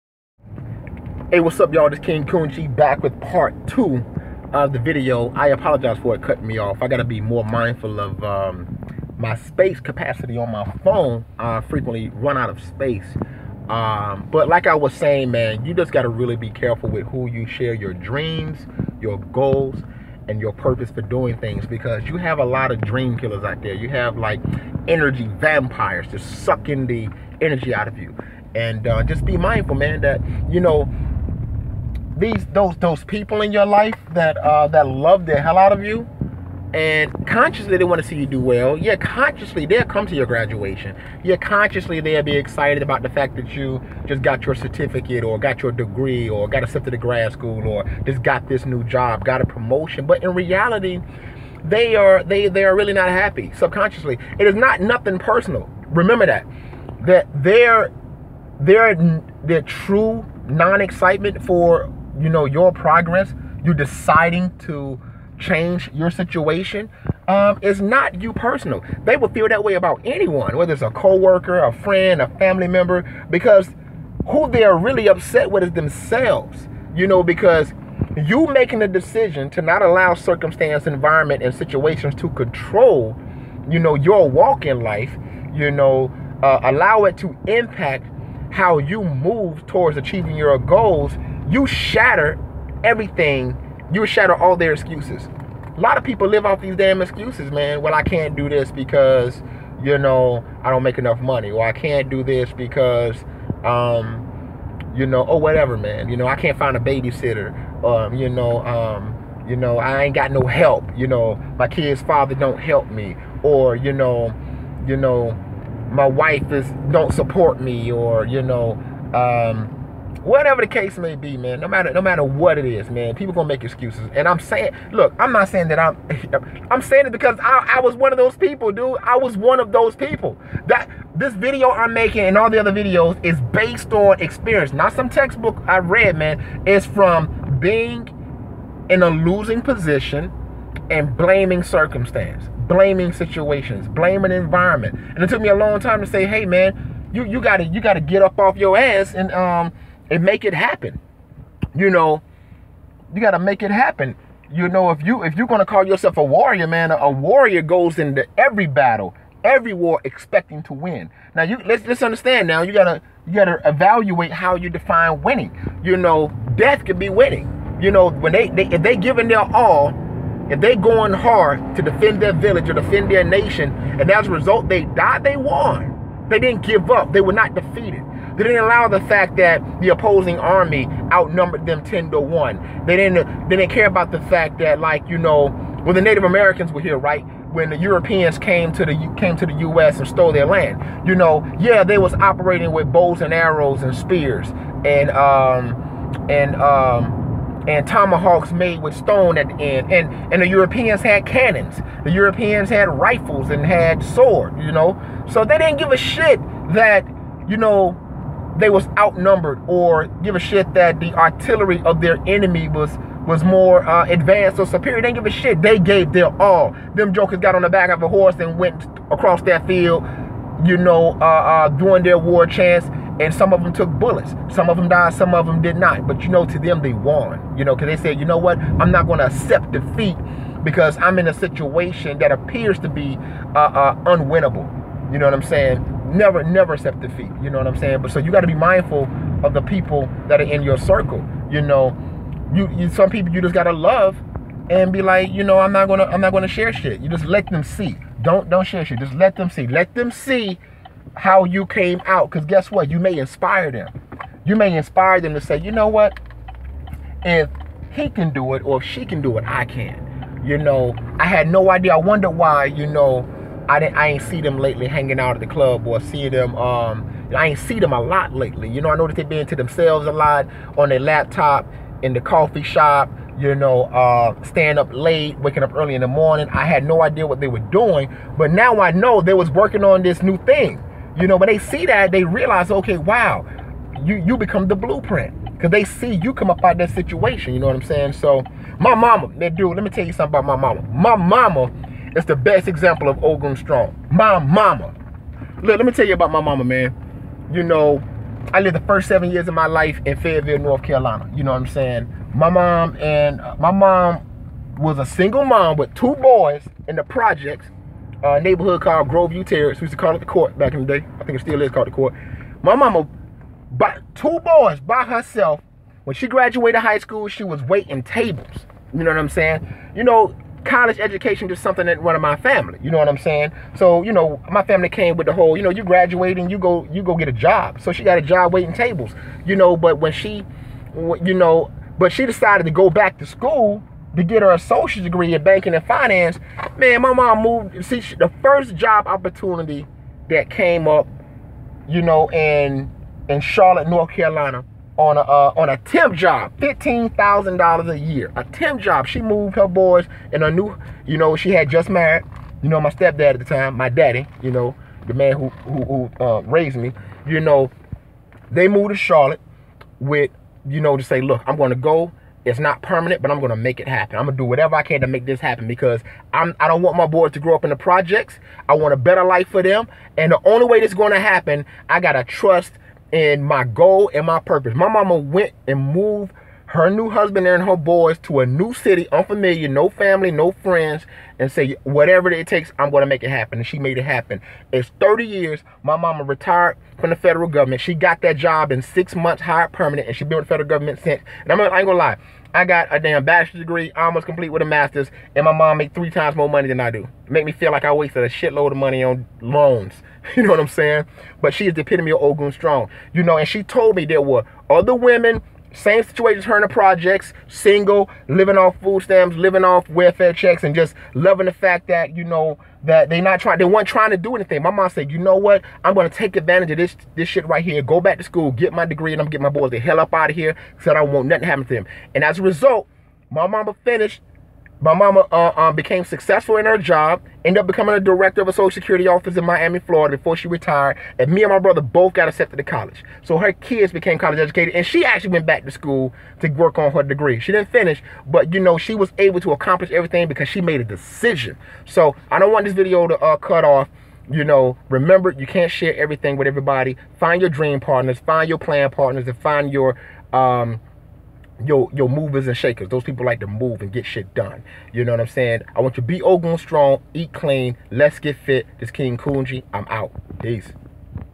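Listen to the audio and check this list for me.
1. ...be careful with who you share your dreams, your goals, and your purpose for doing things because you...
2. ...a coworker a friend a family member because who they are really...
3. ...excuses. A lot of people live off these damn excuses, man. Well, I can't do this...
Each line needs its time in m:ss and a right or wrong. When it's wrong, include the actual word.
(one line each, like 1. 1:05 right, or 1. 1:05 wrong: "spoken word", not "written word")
1. 0:16 right
2. 1:10 right
3. 1:34 right.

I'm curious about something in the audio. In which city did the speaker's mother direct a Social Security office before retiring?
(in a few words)
Miami, Florida.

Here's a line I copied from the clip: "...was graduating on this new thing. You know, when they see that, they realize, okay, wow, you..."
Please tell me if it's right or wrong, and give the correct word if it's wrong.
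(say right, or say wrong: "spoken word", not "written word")
wrong: "working", not "graduating".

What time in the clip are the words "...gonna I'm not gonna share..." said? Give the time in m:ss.
4:05.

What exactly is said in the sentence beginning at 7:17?
She didn't finish, but you know, she was able to accomplish everything because she made a decision.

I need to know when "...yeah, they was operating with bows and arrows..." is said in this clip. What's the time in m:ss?
3:11.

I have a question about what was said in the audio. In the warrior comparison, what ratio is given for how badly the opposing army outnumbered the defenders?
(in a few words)
10 to 1.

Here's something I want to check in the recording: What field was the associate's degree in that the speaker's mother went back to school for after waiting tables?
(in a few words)
banking and finance.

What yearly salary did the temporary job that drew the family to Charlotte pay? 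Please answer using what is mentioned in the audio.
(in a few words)
$15,000.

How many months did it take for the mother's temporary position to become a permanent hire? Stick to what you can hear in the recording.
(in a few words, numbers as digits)
6.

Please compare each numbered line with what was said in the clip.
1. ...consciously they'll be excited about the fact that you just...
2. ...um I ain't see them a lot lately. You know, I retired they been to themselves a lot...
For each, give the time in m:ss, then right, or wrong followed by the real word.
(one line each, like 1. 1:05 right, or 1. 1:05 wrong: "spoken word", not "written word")
1. 0:41 right
2. 4:26 wrong: "noticed", not "retired".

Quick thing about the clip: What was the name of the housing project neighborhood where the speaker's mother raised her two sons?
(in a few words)
Groveview Terrace.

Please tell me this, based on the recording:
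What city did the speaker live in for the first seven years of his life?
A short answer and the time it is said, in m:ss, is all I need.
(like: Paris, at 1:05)
Fayetteville, North Carolina, at 5:00.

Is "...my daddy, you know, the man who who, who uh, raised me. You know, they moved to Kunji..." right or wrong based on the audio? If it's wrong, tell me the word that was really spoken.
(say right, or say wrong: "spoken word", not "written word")
wrong: "Charlotte", not "Kunji".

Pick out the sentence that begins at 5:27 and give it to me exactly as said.
So she got a job waiting tables.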